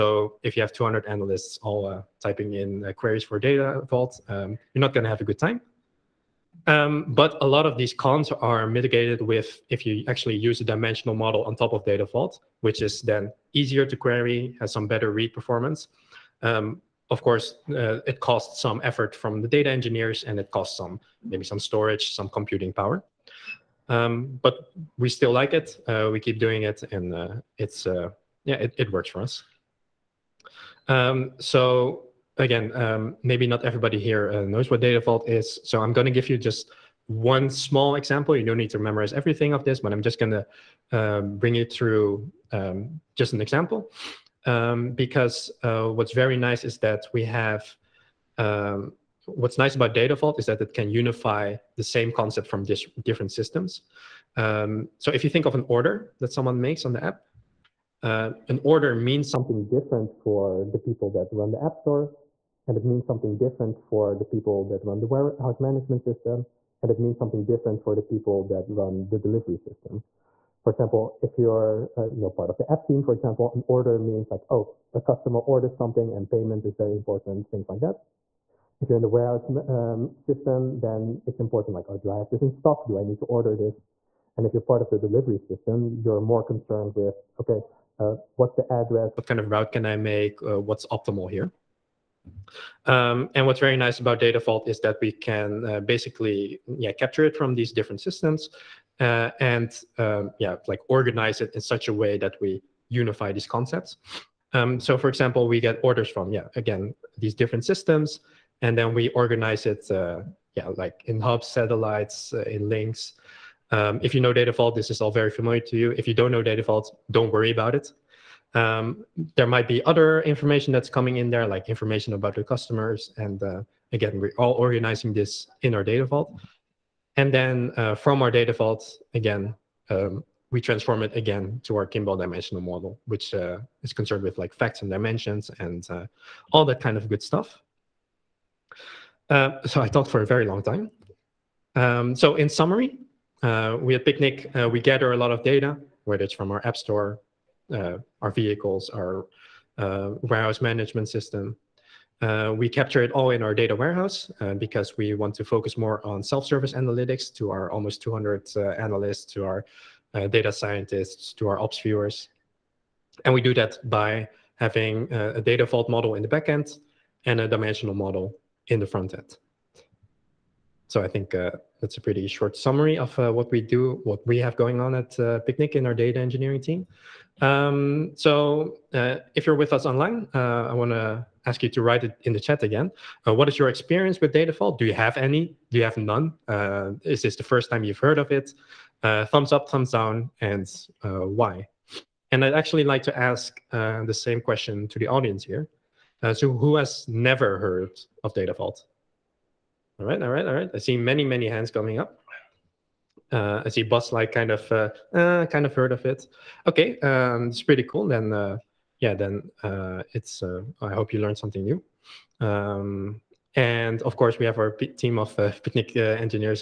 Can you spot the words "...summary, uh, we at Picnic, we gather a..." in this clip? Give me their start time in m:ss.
2:22.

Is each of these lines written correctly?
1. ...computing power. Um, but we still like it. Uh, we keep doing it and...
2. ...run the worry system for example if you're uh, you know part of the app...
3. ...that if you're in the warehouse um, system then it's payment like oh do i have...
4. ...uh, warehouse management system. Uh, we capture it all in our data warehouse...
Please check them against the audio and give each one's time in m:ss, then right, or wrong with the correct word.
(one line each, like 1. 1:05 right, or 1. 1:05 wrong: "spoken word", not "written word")
1. 0:22 right
2. 1:08 wrong: "delivery", not "worry"
3. 1:17 wrong: "important", not "payment"
4. 2:29 right.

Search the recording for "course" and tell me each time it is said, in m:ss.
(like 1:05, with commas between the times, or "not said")
0:17, 3:34.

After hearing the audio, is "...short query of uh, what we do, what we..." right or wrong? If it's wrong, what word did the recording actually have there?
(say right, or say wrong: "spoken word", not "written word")
wrong: "summary", not "query".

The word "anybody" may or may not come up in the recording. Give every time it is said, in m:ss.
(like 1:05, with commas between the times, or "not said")
not said.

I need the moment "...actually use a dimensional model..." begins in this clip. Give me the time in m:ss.
0:10.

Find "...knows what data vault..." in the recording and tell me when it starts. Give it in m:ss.
0:34.